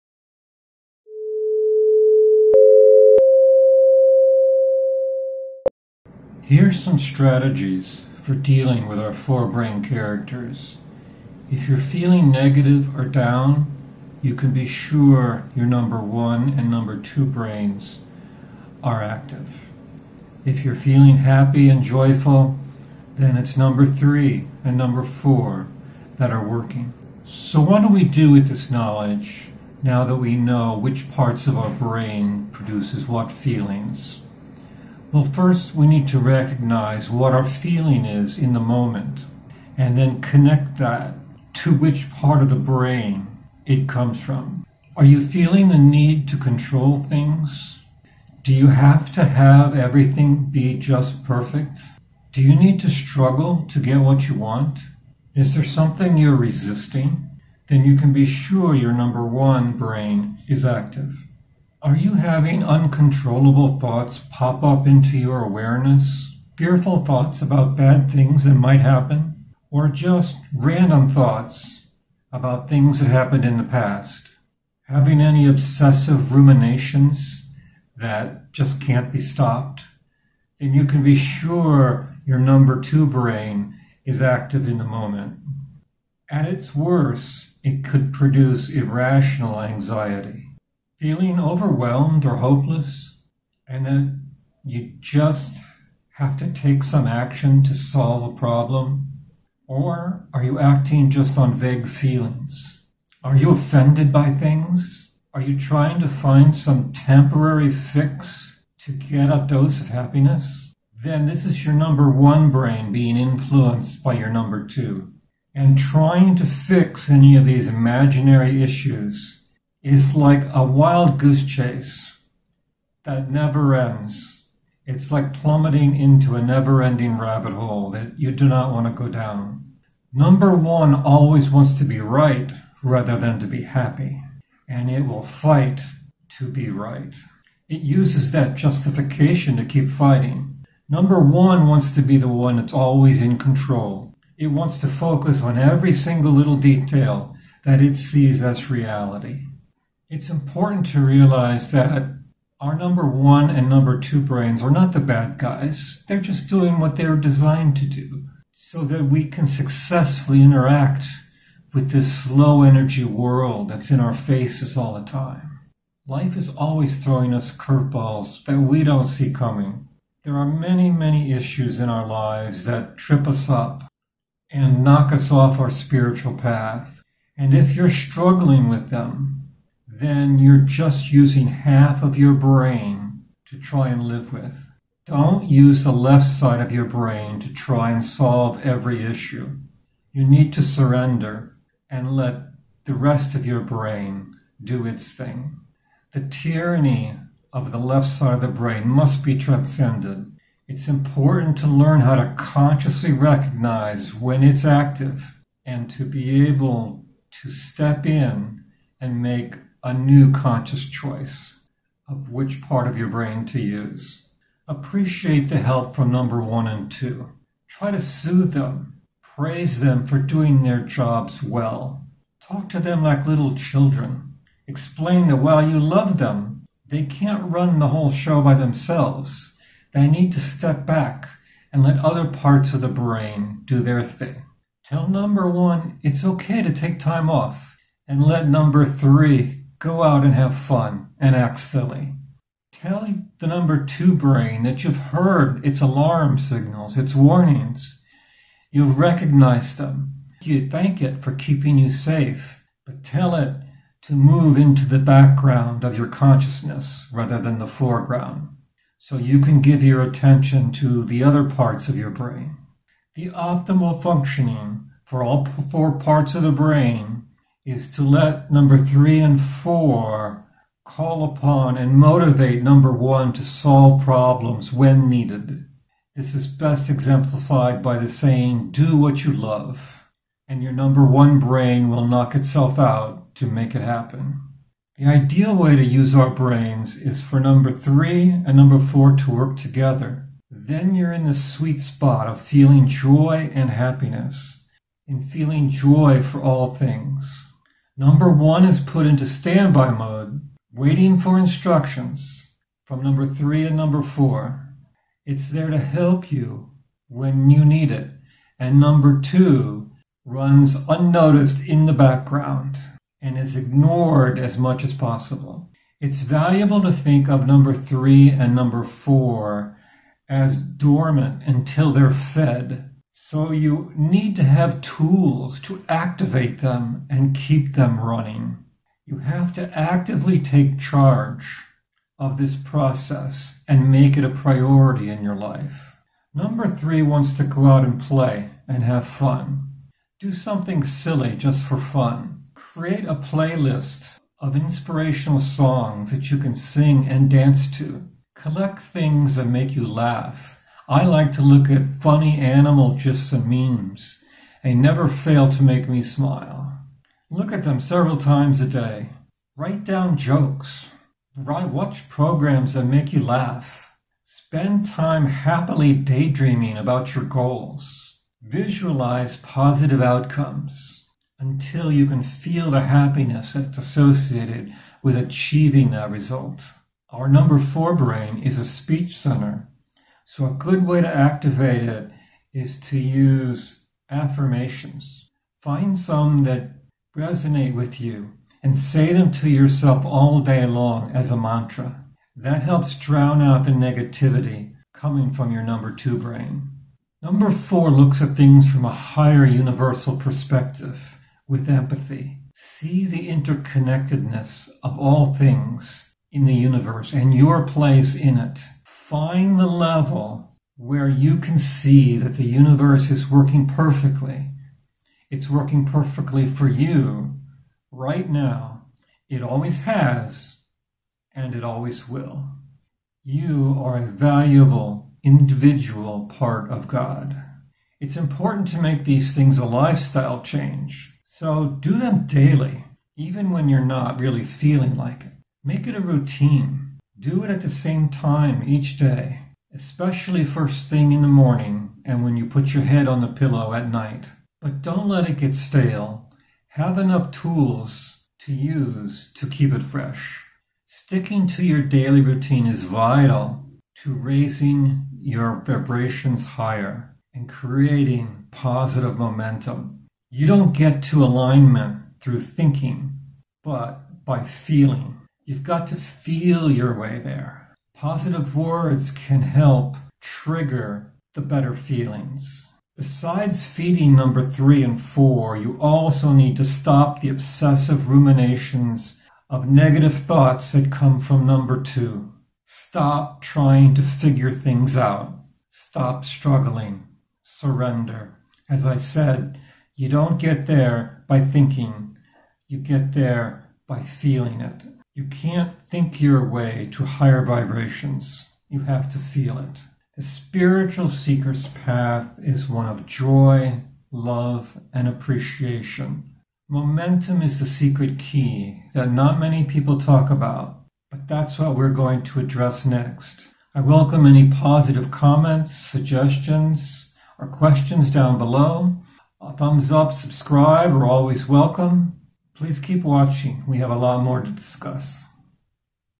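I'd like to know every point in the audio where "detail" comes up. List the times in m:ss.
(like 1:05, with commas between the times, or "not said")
2:26.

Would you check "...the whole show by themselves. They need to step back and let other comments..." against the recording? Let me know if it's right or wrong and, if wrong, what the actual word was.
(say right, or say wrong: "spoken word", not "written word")
wrong: "parts", not "comments".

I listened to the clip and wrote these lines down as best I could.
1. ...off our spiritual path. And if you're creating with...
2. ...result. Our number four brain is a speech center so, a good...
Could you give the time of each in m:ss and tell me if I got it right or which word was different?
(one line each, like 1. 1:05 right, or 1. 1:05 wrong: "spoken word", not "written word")
1. 2:55 wrong: "struggling", not "creating"
2. 6:16 right.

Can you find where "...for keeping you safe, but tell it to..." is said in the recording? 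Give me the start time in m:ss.
4:11.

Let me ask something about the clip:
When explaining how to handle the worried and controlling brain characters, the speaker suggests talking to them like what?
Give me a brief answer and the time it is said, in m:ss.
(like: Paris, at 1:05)
Little children, at 3:43.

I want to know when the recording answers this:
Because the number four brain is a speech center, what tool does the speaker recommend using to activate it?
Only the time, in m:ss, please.
6:24.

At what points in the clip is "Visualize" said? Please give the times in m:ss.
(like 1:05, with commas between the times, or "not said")
6:08.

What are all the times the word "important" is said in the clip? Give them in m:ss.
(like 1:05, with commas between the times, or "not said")
2:30, 3:20, 7:08.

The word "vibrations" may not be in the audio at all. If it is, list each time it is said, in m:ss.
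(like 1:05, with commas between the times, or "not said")
7:35, 8:17.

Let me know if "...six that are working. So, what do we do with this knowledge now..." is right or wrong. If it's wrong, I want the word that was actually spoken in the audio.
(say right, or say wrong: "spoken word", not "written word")
wrong: "four", not "six".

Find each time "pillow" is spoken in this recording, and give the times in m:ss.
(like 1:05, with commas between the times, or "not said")
7:23.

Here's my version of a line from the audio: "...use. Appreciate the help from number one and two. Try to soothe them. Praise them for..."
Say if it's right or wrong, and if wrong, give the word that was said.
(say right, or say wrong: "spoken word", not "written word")
right.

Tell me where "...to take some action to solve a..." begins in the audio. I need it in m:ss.
1:36.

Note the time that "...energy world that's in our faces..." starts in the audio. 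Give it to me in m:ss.
2:42.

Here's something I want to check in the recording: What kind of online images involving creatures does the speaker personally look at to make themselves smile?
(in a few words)
Funny animal gifs.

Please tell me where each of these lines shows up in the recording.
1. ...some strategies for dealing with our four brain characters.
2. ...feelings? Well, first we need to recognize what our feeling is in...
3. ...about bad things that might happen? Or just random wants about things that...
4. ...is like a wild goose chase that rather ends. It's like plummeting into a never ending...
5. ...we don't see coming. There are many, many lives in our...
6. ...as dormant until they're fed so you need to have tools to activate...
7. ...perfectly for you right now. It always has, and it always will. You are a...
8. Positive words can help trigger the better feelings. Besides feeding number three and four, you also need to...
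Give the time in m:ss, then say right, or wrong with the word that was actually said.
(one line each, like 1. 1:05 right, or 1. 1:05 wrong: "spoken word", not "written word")
1. 0:06 right
2. 0:33 right
3. 1:07 wrong: "thoughts", not "wants"
4. 1:59 wrong: "never", not "rather"
5. 2:48 wrong: "issues", not "lives"
6. 5:20 right
7. 6:55 right
8. 7:47 right.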